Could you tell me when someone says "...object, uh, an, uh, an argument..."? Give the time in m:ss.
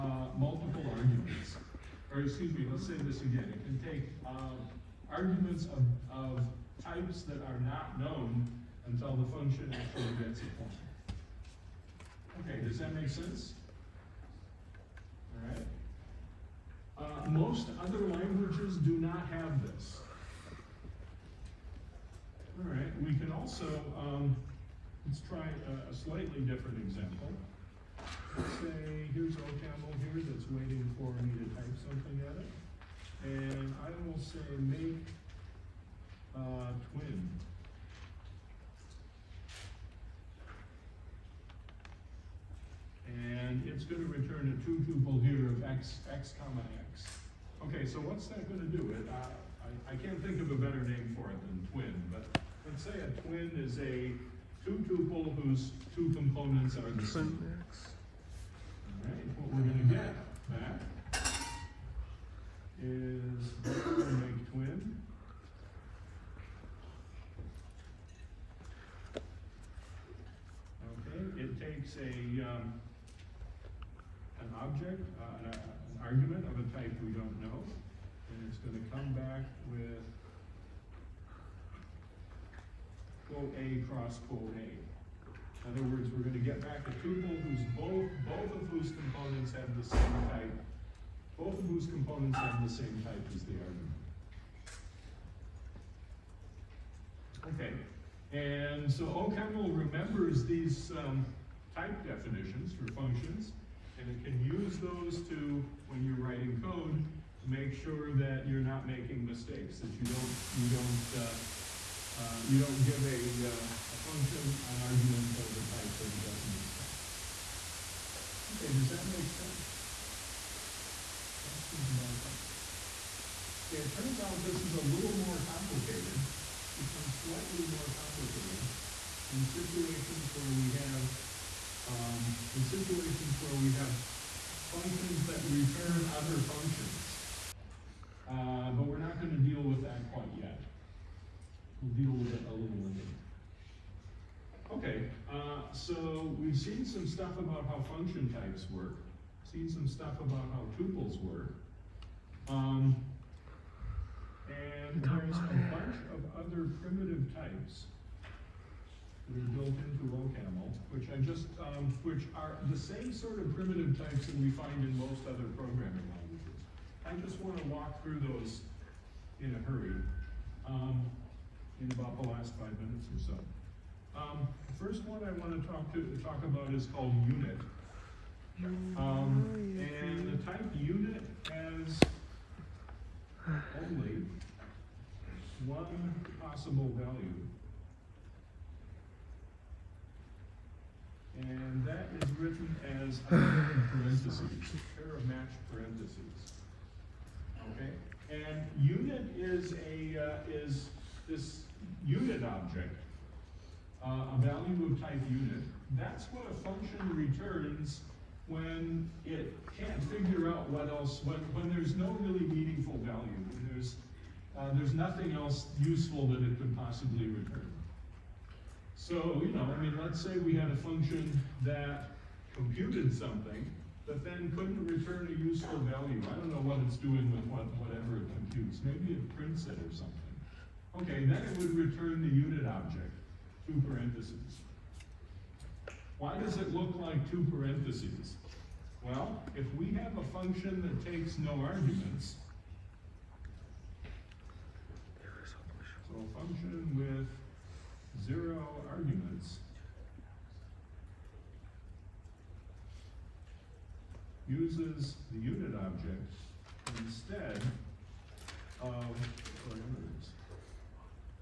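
1:14.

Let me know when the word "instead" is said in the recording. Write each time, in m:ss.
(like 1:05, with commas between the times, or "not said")
4:16.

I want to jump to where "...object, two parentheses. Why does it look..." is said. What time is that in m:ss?
3:52.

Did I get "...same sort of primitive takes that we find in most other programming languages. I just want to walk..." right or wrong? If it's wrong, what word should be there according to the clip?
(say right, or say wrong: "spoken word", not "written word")
wrong: "types", not "takes".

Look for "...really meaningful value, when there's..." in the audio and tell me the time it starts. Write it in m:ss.
3:32.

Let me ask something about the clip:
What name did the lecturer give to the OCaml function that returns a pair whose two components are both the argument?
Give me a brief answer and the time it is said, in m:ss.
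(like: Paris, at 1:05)
make twin, at 0:34.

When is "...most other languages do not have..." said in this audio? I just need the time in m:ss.
0:17.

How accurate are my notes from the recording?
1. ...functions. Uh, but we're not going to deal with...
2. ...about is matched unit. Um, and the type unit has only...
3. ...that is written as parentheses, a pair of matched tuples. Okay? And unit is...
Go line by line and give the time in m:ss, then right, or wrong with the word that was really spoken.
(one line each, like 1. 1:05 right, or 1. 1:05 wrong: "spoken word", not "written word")
1. 2:16 right
2. 2:56 wrong: "called", not "matched"
3. 3:11 wrong: "parentheses", not "tuples".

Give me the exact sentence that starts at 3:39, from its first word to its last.
So, you know, I mean, let's say we had a function that computed something, but then couldn't return a useful value.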